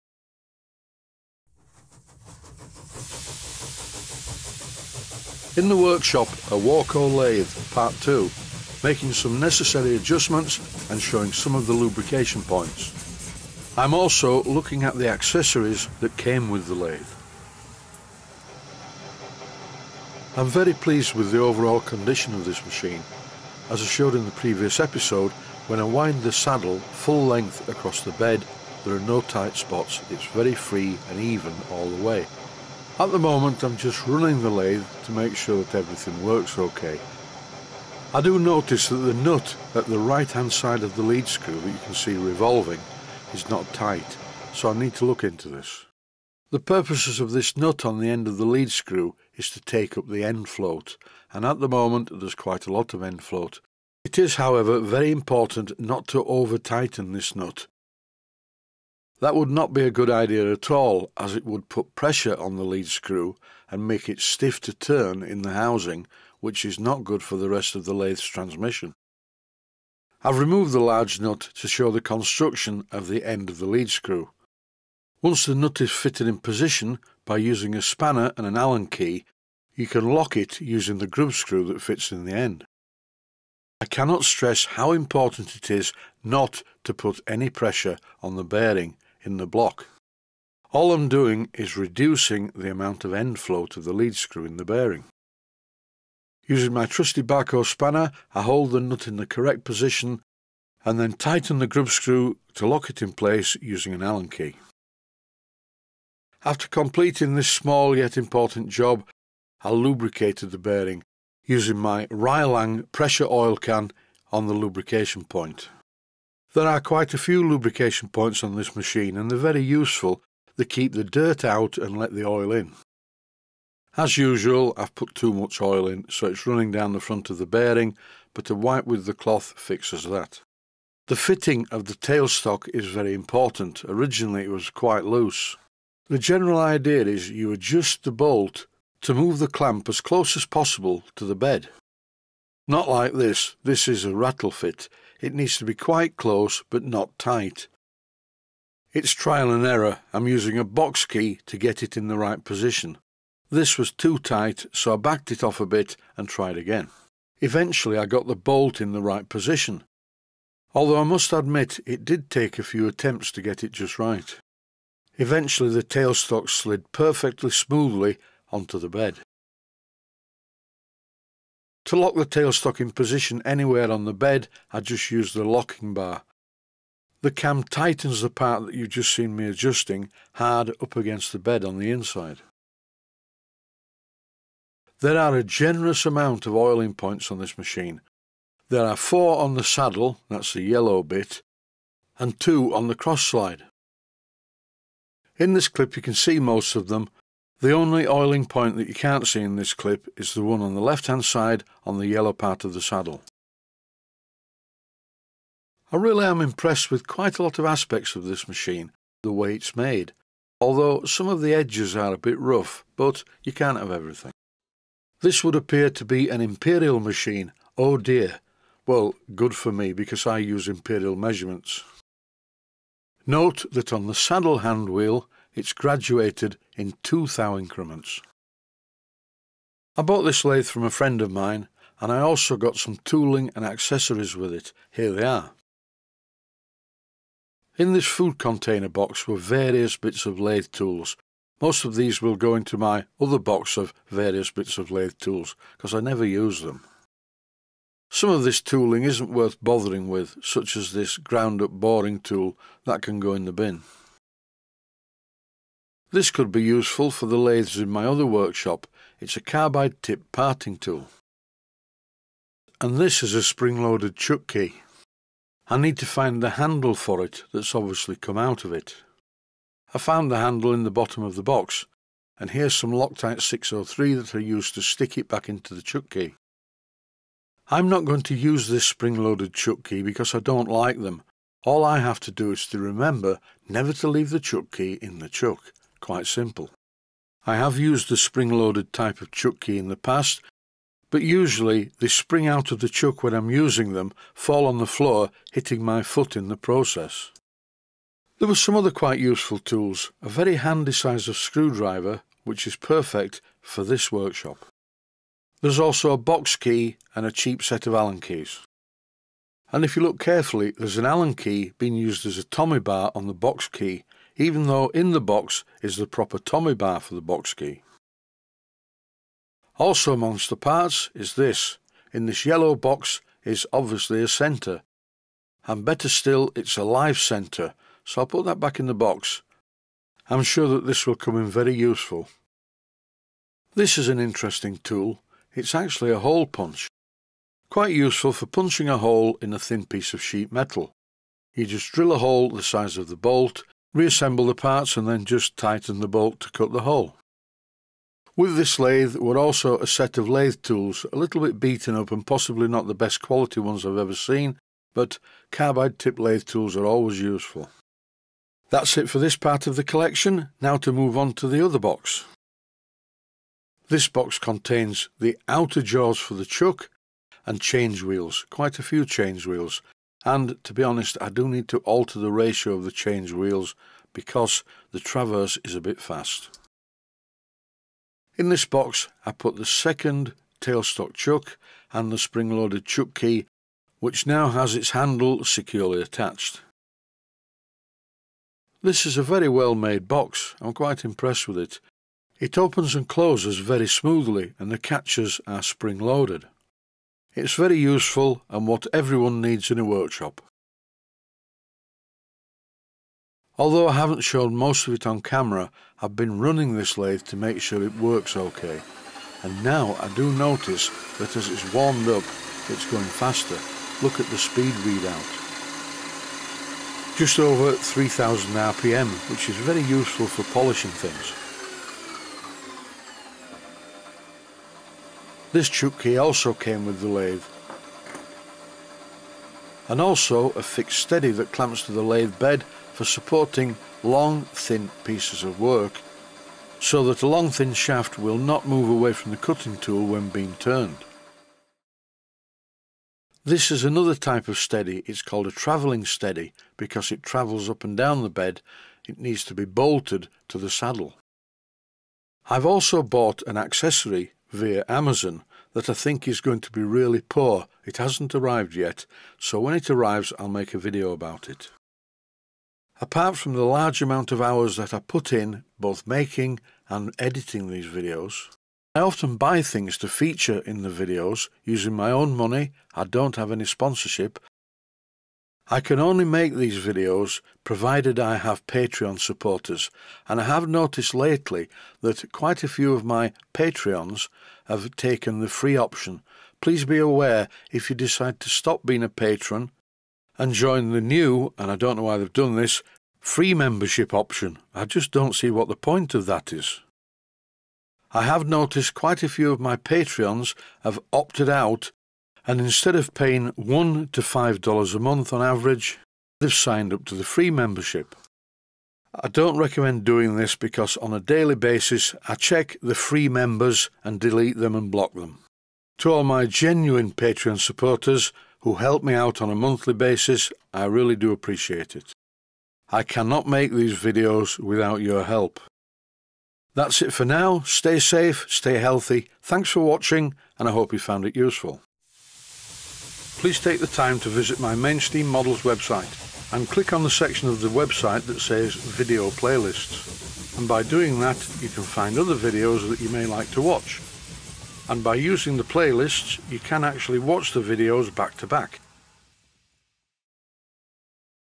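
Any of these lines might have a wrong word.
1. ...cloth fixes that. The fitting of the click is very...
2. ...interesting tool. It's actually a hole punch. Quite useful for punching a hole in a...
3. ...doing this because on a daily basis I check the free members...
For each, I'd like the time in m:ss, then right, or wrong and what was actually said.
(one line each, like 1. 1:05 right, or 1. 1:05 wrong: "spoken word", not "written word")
1. 2:09 wrong: "tailstock", not "click"
2. 5:34 right
3. 8:30 right.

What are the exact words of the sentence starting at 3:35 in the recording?
This would appear to be an imperial machine, oh dear.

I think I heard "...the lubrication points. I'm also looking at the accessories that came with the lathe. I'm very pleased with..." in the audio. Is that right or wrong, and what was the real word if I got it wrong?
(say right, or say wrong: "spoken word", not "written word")
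right.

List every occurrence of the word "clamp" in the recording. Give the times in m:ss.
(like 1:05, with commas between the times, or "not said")
2:19, 7:11.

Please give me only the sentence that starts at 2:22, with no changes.
Not like this, this is a rattle fit.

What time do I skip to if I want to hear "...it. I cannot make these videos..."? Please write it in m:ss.
8:41.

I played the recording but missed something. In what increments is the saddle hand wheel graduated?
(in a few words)
2 thou.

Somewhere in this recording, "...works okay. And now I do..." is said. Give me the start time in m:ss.
6:47.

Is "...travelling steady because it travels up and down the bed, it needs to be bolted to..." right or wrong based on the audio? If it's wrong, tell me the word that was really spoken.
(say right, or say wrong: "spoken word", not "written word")
right.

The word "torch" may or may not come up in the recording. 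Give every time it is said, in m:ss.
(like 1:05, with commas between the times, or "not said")
not said.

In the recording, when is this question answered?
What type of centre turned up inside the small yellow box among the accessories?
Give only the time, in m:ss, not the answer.
5:26.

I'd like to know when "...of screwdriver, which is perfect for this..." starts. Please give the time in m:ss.
5:01.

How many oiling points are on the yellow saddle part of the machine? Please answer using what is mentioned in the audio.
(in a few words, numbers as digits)
4.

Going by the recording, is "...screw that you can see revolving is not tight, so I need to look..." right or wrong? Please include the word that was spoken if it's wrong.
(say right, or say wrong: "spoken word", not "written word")
right.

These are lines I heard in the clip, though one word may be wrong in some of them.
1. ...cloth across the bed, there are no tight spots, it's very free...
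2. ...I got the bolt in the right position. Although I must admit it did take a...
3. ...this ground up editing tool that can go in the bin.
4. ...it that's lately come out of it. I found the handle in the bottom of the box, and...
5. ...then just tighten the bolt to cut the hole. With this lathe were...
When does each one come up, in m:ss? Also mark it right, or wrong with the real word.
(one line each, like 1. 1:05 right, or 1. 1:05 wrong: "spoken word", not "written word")
1. 0:27 wrong: "length", not "cloth"
2. 2:37 right
3. 4:10 wrong: "boring", not "editing"
4. 4:27 wrong: "obviously", not "lately"
5. 5:45 right.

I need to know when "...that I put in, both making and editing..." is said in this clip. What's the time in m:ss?
7:44.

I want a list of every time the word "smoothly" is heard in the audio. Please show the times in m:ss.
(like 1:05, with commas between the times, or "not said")
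2:47, 6:33.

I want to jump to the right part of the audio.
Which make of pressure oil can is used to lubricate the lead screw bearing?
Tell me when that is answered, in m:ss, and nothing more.
1:52.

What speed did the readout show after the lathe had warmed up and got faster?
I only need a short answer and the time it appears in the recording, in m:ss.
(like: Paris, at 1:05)
Just over 3000 RPM, at 6:57.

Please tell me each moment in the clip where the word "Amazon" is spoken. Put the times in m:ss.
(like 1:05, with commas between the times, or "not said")
7:34.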